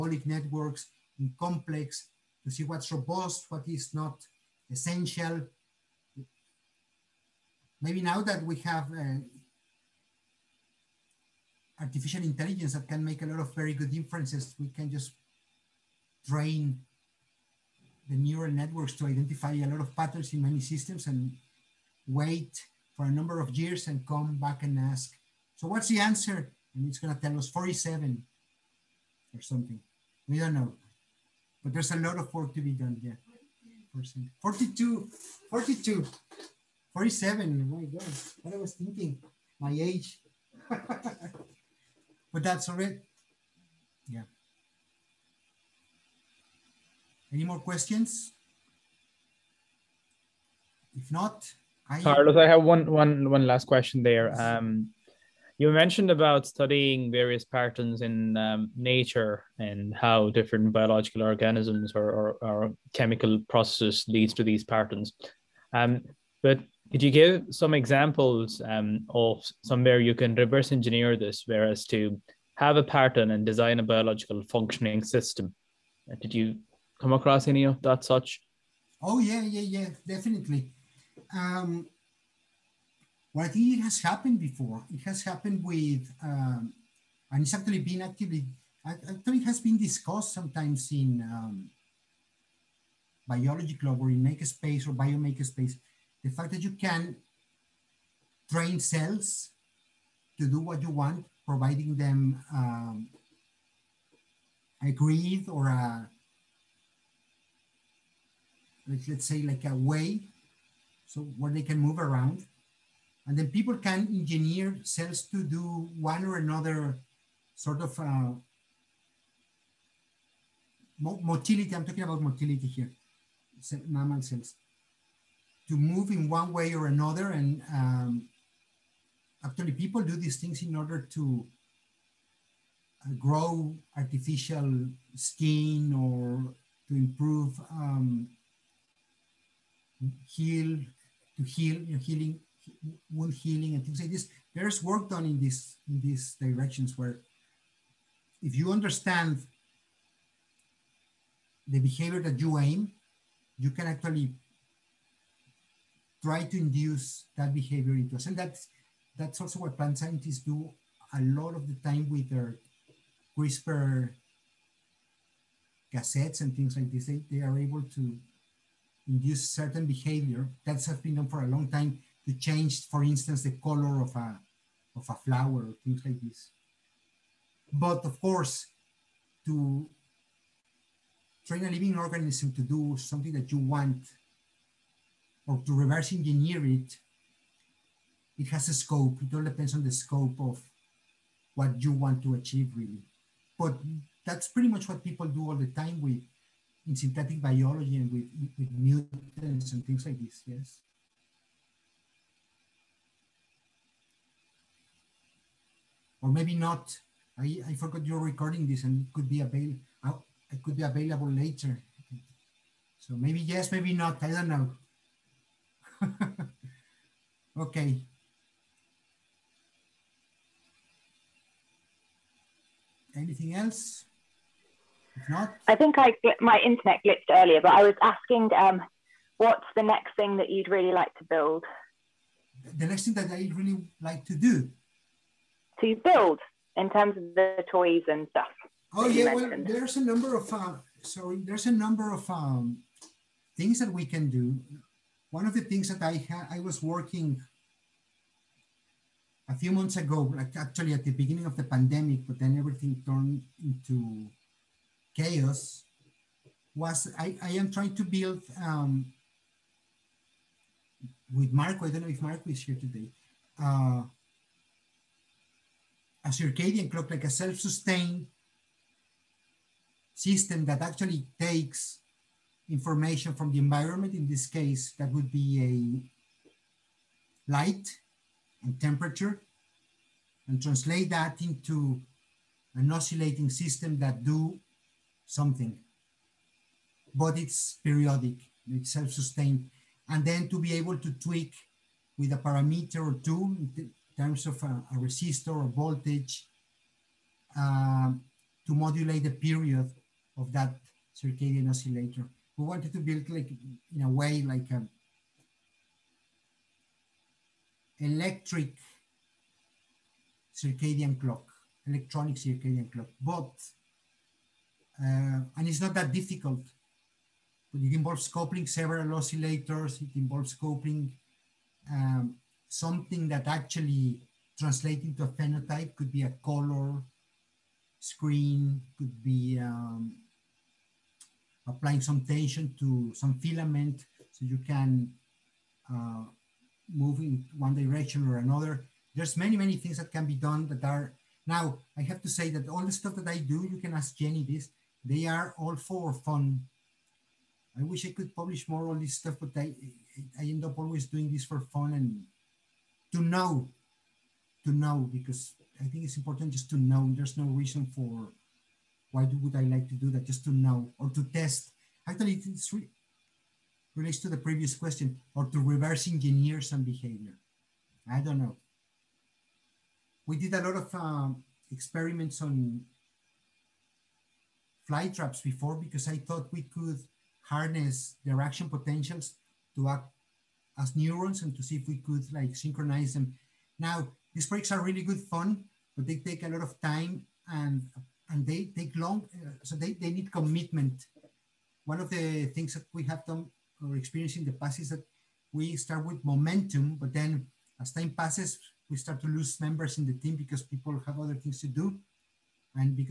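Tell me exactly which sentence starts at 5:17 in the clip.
But it involves coupling several oscillators.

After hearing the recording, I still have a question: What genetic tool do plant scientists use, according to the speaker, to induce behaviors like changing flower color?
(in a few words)
CRISPR cassettes.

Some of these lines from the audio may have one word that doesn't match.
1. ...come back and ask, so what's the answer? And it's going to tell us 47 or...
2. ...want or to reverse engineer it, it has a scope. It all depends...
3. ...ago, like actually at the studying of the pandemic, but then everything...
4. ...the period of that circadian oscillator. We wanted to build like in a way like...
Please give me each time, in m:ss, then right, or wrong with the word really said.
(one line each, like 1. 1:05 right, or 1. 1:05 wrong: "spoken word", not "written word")
1. 0:24 right
2. 3:03 right
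3. 4:09 wrong: "beginning", not "studying"
4. 4:59 right.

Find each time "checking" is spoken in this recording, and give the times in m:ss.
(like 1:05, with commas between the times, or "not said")
not said.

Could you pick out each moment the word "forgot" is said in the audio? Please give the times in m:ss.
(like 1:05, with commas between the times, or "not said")
3:27.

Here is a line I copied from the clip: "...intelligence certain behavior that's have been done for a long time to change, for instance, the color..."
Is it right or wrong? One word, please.
wrong.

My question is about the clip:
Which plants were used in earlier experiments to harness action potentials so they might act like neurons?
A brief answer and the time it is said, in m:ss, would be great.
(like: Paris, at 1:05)
Fly traps, at 6:14.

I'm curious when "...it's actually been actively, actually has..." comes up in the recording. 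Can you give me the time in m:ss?
1:27.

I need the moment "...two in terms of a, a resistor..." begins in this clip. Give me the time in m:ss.
4:53.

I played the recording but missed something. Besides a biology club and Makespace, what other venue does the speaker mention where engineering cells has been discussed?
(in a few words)
Biomakespace.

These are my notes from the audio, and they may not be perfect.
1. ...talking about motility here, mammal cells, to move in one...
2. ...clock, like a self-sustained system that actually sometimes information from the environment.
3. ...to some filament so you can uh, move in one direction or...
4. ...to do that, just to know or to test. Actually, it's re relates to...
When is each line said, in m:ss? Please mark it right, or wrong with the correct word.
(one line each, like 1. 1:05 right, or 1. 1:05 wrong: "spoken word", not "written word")
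1. 2:01 right
2. 4:26 wrong: "takes", not "sometimes"
3. 5:32 right
4. 5:59 right.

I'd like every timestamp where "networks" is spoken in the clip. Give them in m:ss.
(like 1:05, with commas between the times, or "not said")
0:00, 0:18.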